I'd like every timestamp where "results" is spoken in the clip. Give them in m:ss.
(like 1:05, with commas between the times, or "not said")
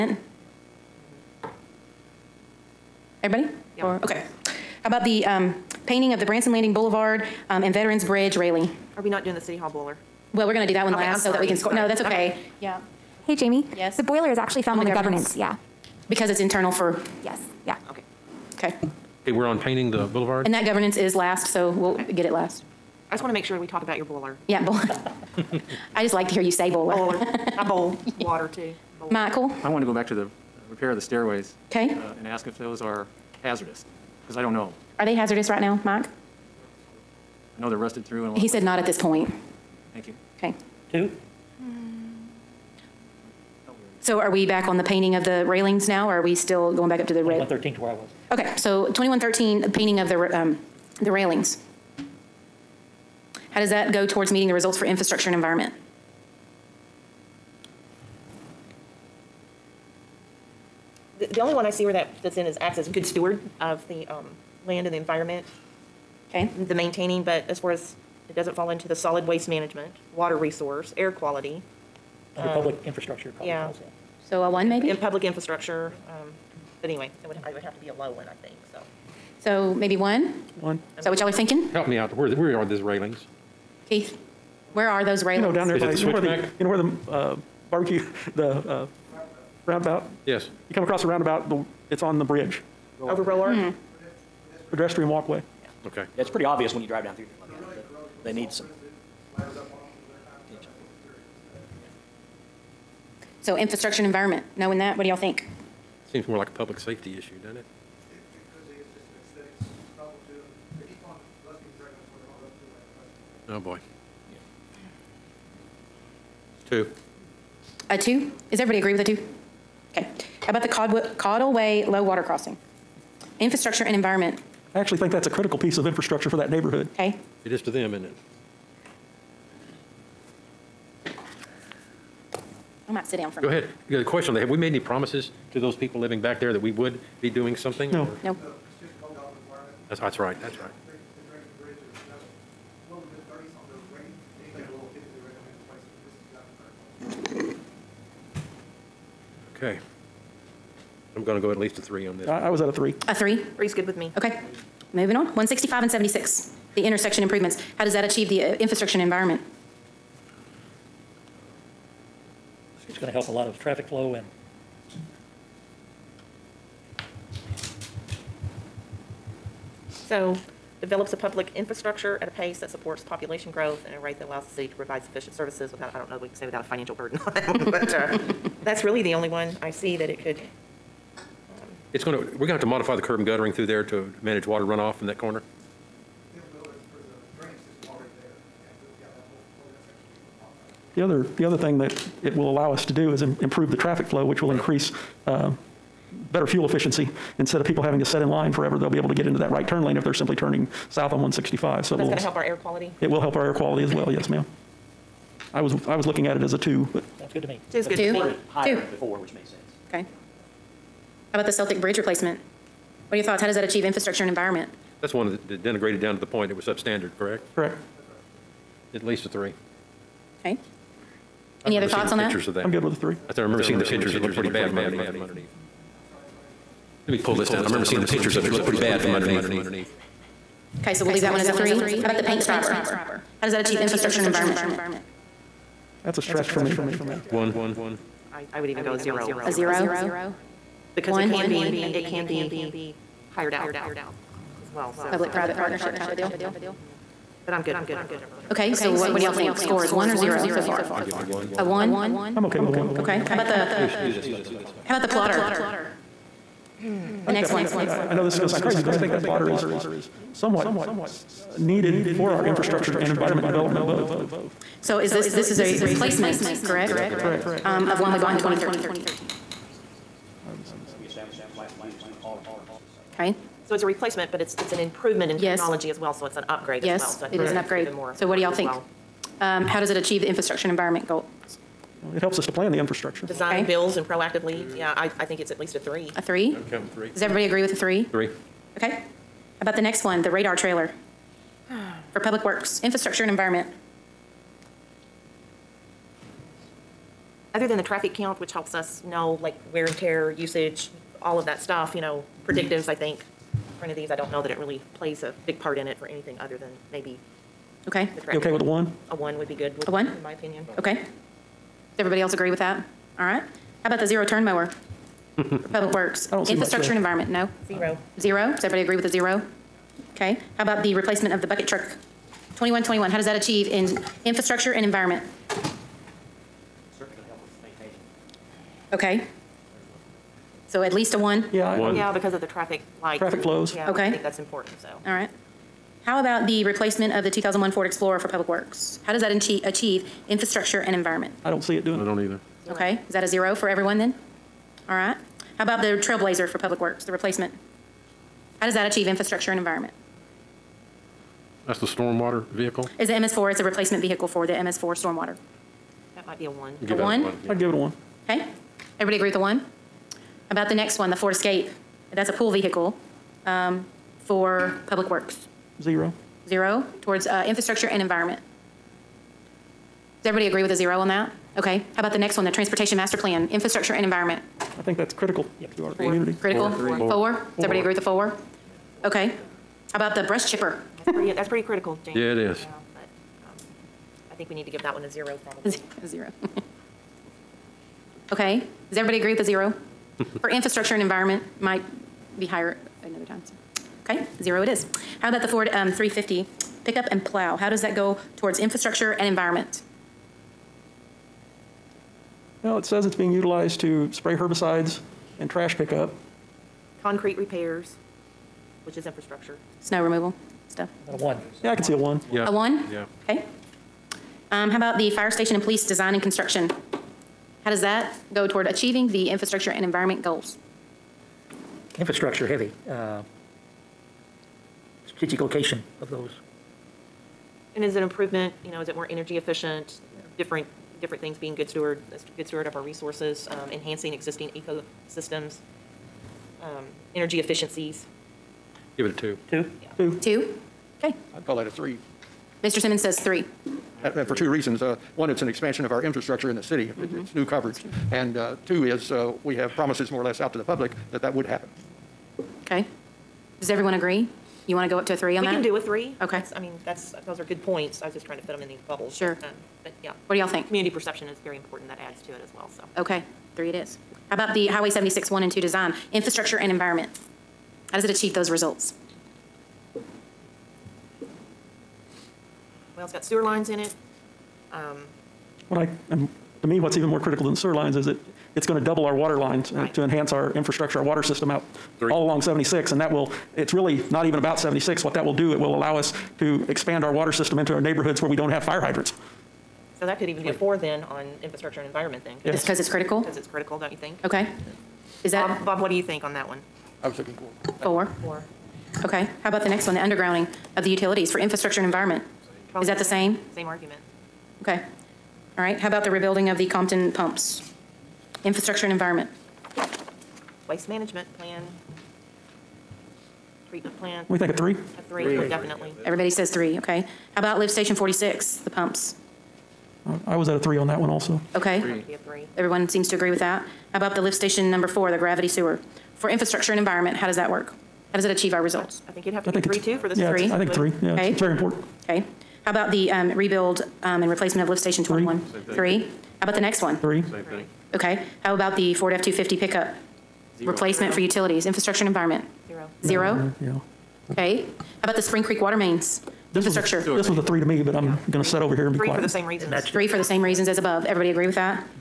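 0:54, 7:48, 8:48.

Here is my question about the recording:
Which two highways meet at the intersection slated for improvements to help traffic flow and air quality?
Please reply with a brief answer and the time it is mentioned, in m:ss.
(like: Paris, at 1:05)
165 and 76, at 2:35.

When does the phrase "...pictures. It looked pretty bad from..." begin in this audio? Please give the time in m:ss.
3:43.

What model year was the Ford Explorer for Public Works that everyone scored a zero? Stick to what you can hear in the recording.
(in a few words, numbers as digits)
2001.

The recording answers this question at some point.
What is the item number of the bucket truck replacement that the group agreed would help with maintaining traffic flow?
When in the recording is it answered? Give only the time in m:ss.
5:22.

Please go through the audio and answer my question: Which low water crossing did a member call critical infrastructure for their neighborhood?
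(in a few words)
Caudalway.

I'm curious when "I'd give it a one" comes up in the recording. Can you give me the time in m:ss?
5:57.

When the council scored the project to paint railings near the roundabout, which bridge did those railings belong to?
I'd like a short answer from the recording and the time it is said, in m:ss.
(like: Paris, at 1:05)
Veterans Bridge, at 0:07.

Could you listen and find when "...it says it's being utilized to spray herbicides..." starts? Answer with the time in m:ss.
6:42.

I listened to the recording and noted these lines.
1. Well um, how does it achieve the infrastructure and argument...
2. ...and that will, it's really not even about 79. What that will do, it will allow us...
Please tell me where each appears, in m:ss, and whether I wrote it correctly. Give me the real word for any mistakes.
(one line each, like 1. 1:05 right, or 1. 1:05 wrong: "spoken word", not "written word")
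1. 4:38 wrong: "environment", not "argument"
2. 8:02 wrong: "76", not "79".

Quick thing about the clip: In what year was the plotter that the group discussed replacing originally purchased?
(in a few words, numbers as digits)
2013.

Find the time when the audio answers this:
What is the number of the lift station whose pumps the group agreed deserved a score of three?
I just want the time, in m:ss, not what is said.
8:37.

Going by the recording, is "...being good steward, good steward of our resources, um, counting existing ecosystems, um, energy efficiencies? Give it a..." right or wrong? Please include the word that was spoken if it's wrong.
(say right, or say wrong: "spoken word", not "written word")
wrong: "enhancing", not "counting".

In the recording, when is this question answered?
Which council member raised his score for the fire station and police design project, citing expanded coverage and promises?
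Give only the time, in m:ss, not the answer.
7:22.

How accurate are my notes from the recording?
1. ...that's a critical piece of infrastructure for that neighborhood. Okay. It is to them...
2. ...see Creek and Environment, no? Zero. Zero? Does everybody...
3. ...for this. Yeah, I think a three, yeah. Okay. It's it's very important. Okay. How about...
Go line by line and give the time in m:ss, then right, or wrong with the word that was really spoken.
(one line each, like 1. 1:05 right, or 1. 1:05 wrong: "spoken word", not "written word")
1. 2:05 right
2. 5:16 wrong: "Infrastructure", not "Creek"
3. 8:49 right.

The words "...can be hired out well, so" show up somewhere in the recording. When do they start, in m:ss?
4:02.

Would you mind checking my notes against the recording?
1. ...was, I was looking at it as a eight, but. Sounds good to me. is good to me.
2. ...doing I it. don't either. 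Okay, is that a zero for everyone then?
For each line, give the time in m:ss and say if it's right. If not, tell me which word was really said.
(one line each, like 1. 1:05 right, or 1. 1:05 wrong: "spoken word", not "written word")
1. 3:25 wrong: "two", not "eight"
2. 5:41 right.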